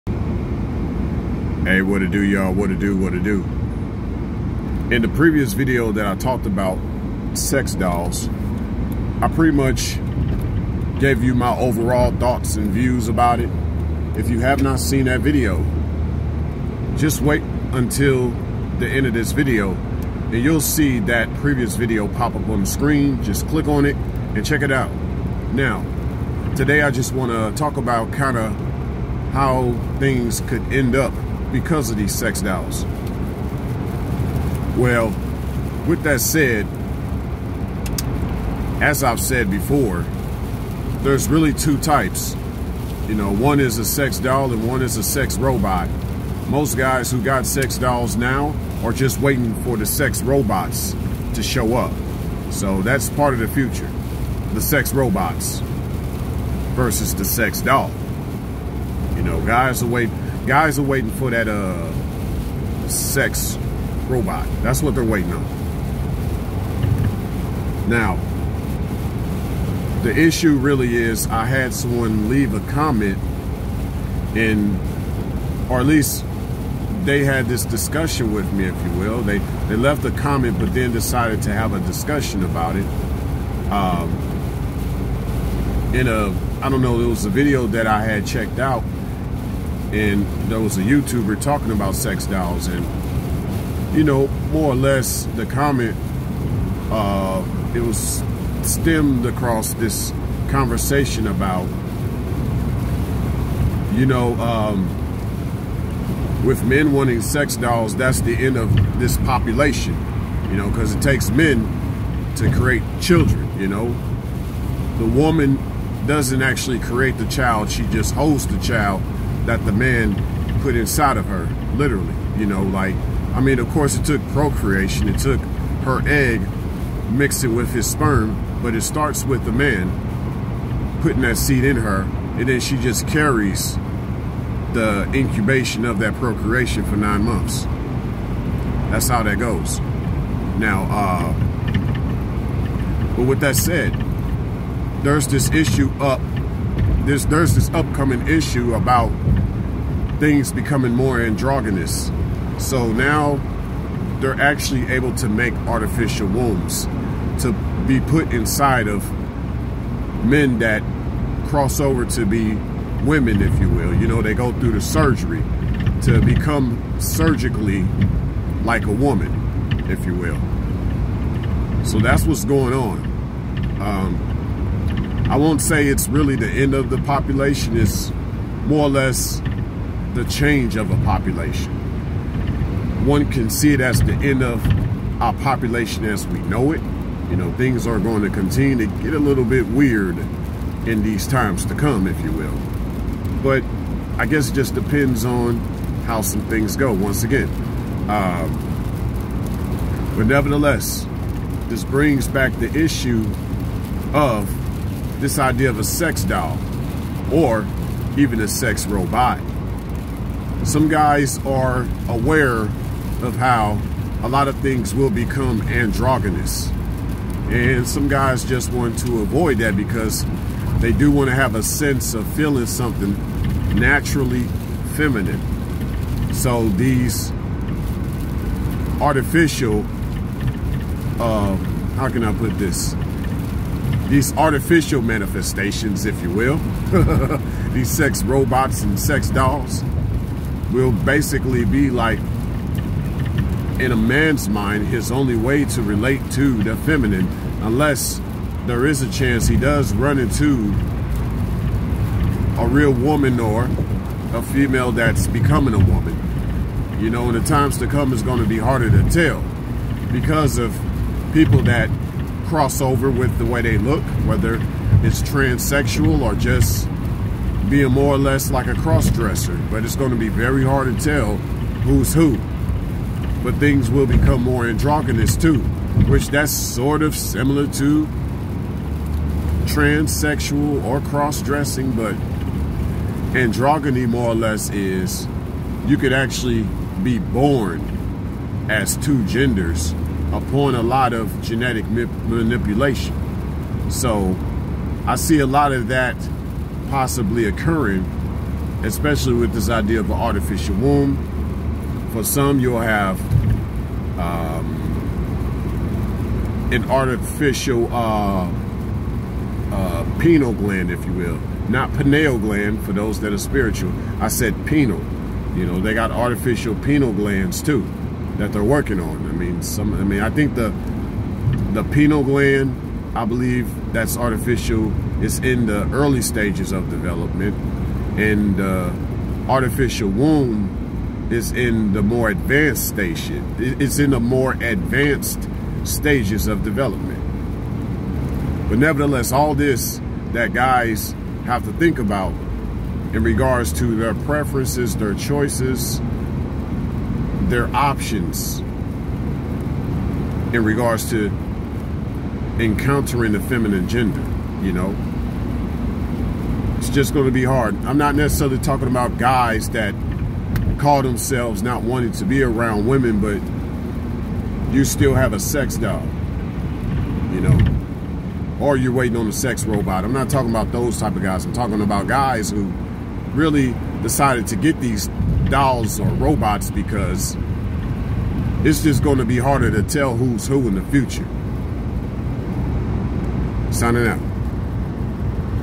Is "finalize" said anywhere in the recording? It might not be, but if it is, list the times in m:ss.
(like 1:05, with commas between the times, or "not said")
not said.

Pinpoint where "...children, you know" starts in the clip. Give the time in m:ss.
1:53.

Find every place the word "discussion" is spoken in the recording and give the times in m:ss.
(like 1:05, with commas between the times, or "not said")
1:17, 1:21.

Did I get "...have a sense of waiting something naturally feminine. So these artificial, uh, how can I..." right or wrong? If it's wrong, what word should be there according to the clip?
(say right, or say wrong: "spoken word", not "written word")
wrong: "feeling", not "waiting".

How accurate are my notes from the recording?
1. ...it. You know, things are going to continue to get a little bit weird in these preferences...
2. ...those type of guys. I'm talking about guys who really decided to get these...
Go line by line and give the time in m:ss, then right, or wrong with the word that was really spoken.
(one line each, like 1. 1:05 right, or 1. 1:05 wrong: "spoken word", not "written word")
1. 3:06 wrong: "times", not "preferences"
2. 6:10 right.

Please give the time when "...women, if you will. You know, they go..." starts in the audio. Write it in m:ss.
2:43.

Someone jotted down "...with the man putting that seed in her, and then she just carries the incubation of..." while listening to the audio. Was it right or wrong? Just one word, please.
right.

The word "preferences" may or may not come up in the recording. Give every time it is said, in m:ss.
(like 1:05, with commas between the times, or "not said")
5:44.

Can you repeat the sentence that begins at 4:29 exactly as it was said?
But it's going to be very hard to tell who's who.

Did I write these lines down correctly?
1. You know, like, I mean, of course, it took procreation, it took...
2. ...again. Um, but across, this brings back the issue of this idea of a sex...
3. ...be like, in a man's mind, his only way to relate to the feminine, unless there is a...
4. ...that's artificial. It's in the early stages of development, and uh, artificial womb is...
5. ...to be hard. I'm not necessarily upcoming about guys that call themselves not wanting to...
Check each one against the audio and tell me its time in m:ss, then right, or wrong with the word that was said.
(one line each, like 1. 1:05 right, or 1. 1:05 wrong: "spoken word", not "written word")
1. 2:02 right
2. 3:17 wrong: "nevertheless", not "across"
3. 4:01 right
4. 5:23 right
5. 5:57 wrong: "talking", not "upcoming".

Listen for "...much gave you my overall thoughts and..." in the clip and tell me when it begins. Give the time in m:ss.
0:09.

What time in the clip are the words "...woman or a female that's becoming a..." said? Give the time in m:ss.
4:12.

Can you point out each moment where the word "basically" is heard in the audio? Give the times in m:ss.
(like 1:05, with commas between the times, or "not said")
4:00.